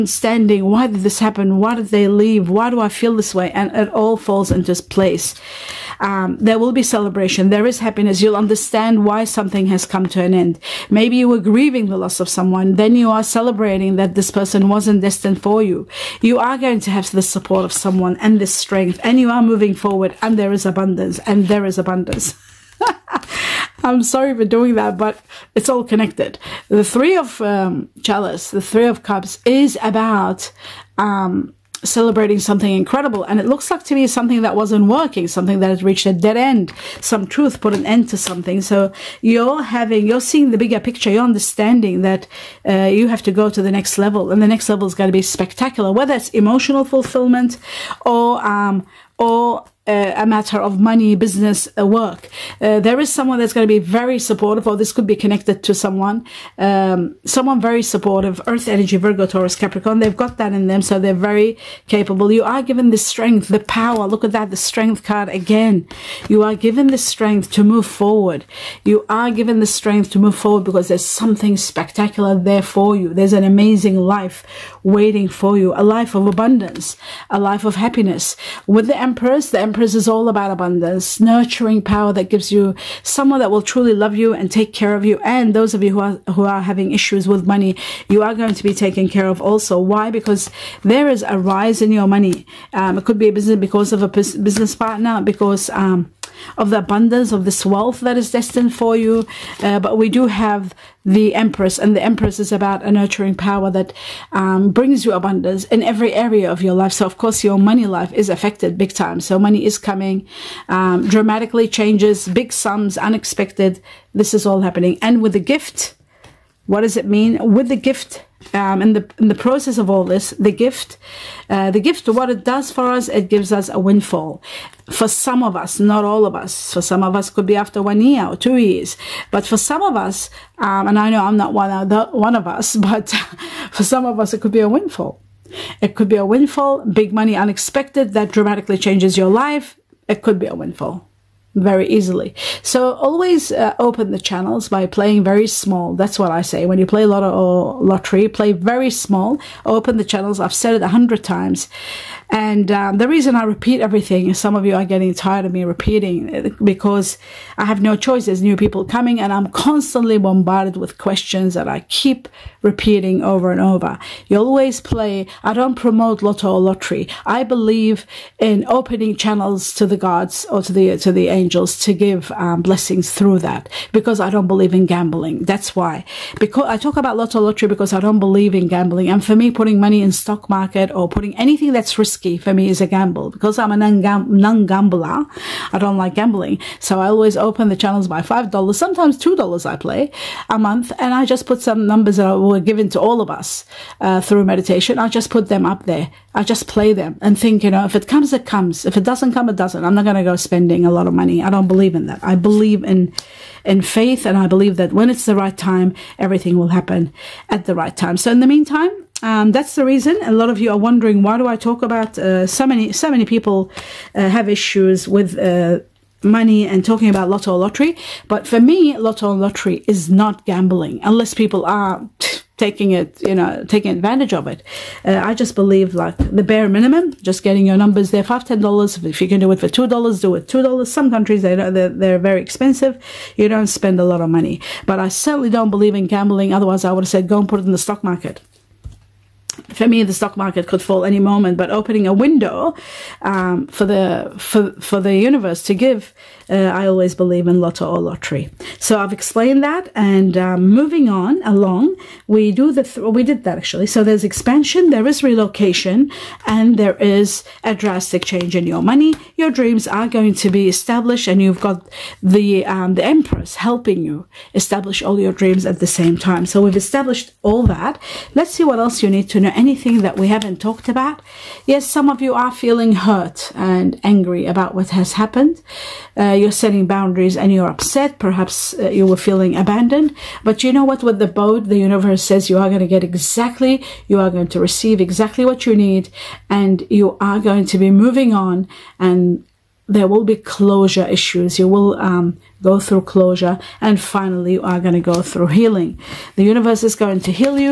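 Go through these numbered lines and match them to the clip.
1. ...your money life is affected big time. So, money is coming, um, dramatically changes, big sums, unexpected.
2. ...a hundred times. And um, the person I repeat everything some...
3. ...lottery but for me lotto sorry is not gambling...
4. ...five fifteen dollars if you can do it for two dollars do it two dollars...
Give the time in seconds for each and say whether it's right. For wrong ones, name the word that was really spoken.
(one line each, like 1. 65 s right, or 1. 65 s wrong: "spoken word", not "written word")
1. 107 s right
2. 150 s wrong: "reason", not "person"
3. 217 s wrong: "lottery", not "sorry"
4. 228 s wrong: "ten", not "fifteen".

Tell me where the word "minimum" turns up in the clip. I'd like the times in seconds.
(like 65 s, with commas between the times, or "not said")
226 s.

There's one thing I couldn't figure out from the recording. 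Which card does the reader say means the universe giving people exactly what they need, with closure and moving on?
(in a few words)
The boat.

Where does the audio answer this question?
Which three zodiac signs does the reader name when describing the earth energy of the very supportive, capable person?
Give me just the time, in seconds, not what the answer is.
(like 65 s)
58 s.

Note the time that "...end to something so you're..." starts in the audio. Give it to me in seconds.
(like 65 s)
37 s.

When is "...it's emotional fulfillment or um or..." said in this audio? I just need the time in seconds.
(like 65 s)
46 s.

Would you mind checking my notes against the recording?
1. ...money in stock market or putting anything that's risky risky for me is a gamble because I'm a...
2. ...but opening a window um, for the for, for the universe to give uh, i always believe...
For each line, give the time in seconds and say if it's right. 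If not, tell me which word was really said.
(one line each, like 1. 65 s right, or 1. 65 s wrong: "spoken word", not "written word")
1. 179 s right
2. 241 s right.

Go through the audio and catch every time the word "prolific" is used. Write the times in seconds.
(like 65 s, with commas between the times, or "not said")
not said.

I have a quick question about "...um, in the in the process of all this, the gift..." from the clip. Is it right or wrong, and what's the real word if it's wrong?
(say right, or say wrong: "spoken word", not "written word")
right.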